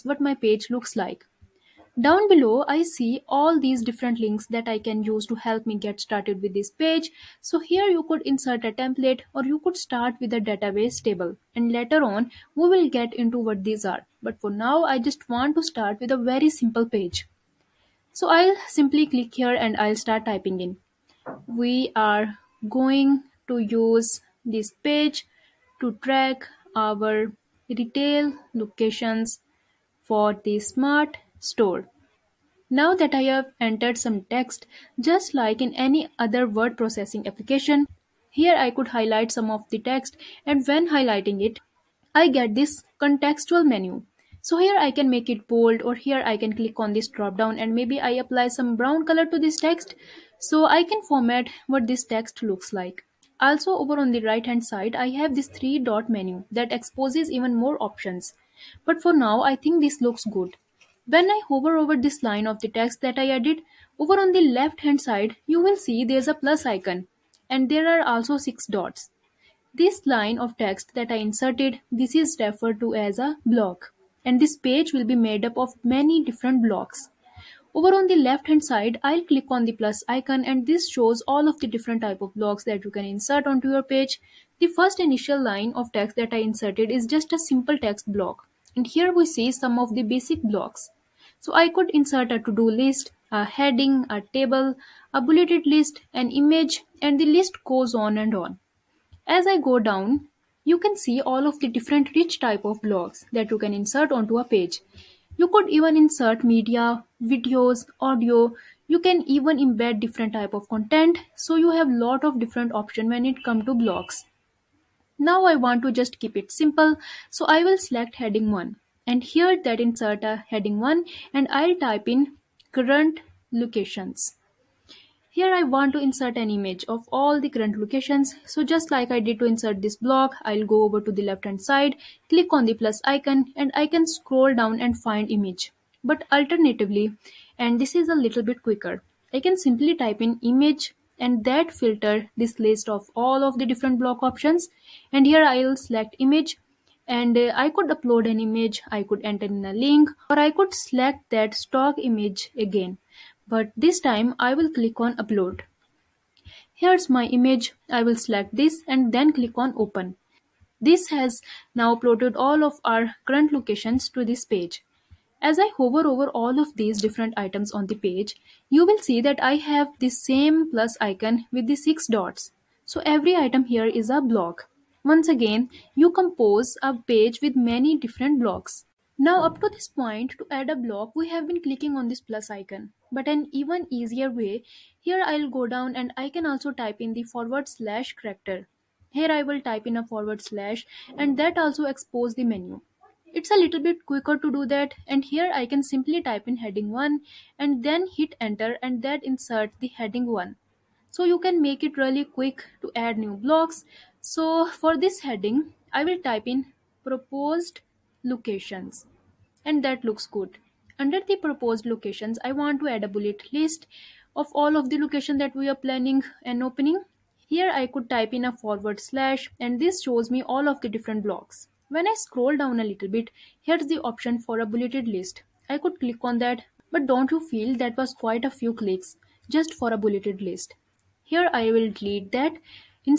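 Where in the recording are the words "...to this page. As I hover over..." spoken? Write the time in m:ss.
2:44.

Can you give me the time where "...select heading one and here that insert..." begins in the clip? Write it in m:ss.
1:57.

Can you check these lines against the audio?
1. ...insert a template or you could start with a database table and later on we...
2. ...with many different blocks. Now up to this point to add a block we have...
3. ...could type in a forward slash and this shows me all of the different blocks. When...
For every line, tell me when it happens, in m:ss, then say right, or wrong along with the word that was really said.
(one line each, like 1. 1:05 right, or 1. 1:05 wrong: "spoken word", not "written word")
1. 0:08 right
2. 2:57 right
3. 3:37 right.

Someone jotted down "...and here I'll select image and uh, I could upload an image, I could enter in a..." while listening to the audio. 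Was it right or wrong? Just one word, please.
right.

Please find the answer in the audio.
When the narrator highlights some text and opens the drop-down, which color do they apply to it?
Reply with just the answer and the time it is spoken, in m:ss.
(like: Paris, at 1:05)
Brown, at 0:48.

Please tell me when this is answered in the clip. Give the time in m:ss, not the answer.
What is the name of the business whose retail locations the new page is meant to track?
0:30.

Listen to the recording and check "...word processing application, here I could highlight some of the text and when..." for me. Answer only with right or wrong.
right.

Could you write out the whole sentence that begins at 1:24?
The first initial line of text that I inserted is just a simple text block.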